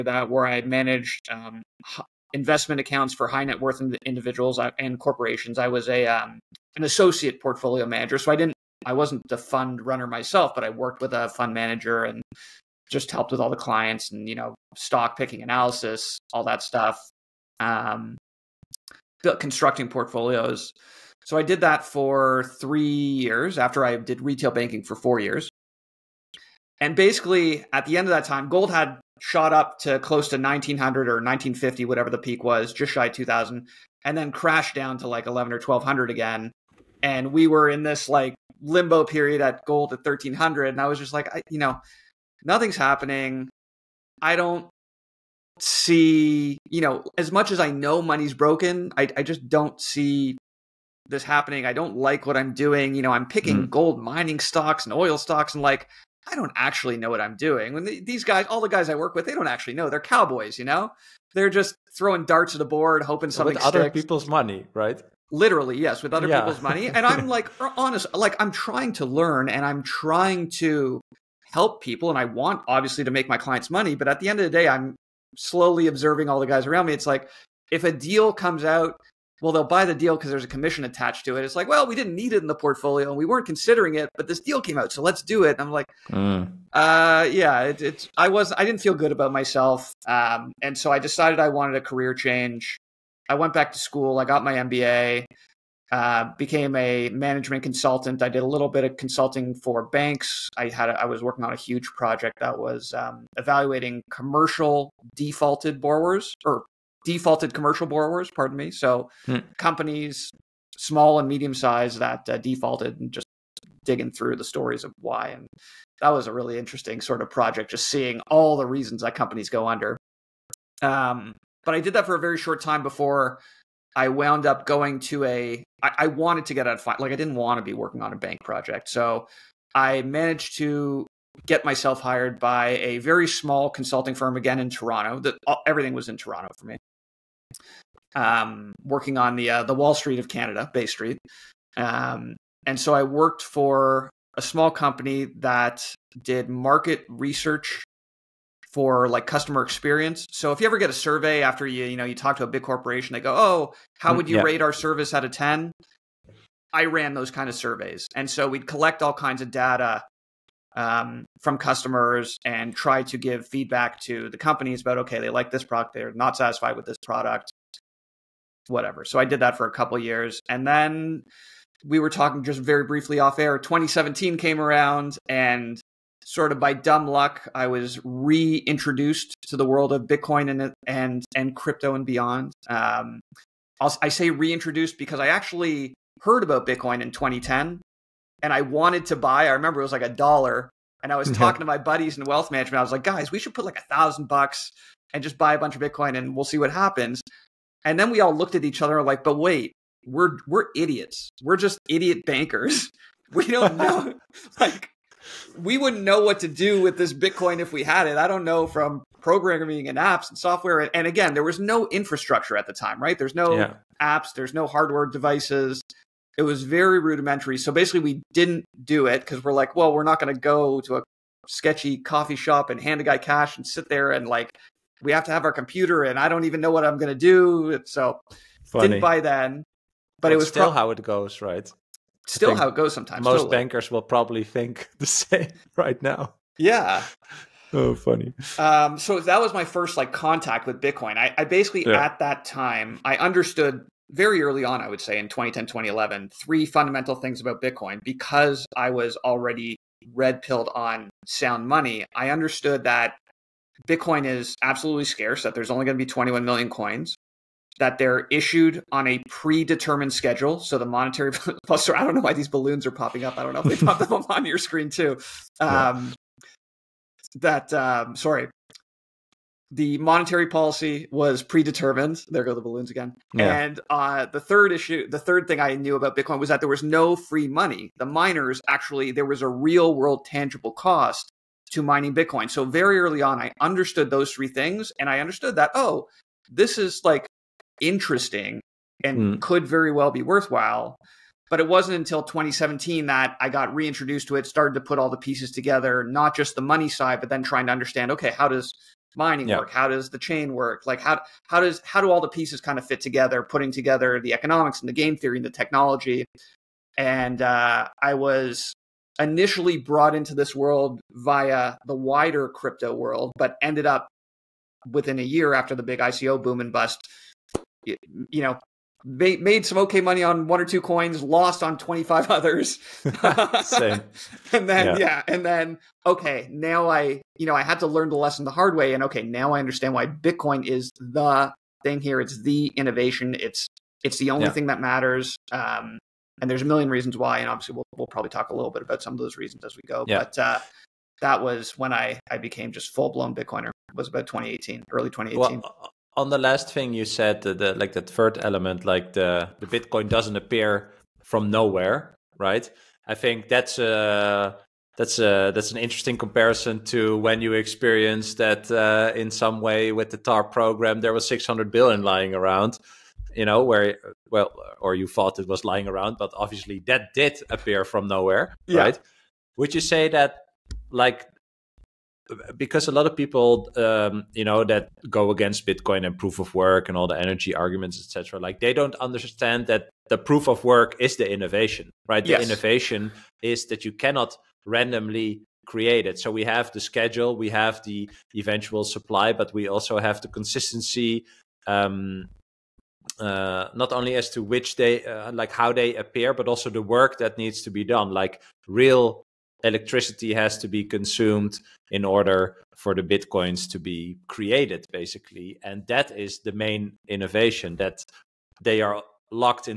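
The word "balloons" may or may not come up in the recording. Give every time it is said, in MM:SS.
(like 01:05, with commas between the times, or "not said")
04:22, 04:32.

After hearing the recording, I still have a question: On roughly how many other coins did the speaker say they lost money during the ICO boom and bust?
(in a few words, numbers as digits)
25.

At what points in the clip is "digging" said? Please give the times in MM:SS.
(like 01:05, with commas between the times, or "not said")
01:53.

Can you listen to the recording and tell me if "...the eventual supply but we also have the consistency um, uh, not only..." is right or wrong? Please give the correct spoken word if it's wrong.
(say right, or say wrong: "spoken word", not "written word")
right.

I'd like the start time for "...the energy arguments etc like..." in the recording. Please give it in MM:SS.
06:17.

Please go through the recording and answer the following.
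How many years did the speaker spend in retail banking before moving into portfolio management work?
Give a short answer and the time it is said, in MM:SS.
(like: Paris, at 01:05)
4, at 00:24.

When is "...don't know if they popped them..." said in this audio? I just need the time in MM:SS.
04:23.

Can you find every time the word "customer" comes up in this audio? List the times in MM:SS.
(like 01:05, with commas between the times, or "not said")
02:29, 02:41.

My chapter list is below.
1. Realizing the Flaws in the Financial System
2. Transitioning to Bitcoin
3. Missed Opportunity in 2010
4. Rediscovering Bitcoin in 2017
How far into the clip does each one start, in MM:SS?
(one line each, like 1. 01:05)
1. 00:46
2. 01:54
3. 02:44
4. 04:43.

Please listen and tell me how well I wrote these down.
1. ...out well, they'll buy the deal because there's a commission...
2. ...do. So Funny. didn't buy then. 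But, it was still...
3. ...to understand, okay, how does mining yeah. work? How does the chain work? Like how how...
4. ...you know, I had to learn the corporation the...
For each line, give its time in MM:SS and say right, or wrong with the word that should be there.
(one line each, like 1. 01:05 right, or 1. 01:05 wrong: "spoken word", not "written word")
1. 01:18 right
2. 03:47 right
3. 04:57 right
4. 05:27 wrong: "lesson", not "corporation".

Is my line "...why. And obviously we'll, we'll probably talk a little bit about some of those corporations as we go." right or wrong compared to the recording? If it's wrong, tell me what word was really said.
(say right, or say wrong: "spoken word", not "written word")
wrong: "reasons", not "corporations".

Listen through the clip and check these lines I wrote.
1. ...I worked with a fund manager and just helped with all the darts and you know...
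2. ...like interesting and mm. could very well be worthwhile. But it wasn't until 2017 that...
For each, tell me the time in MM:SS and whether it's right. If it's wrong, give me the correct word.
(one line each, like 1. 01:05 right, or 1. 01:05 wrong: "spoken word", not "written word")
1. 00:10 wrong: "clients", not "darts"
2. 04:47 right.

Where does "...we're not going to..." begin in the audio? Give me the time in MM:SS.
03:39.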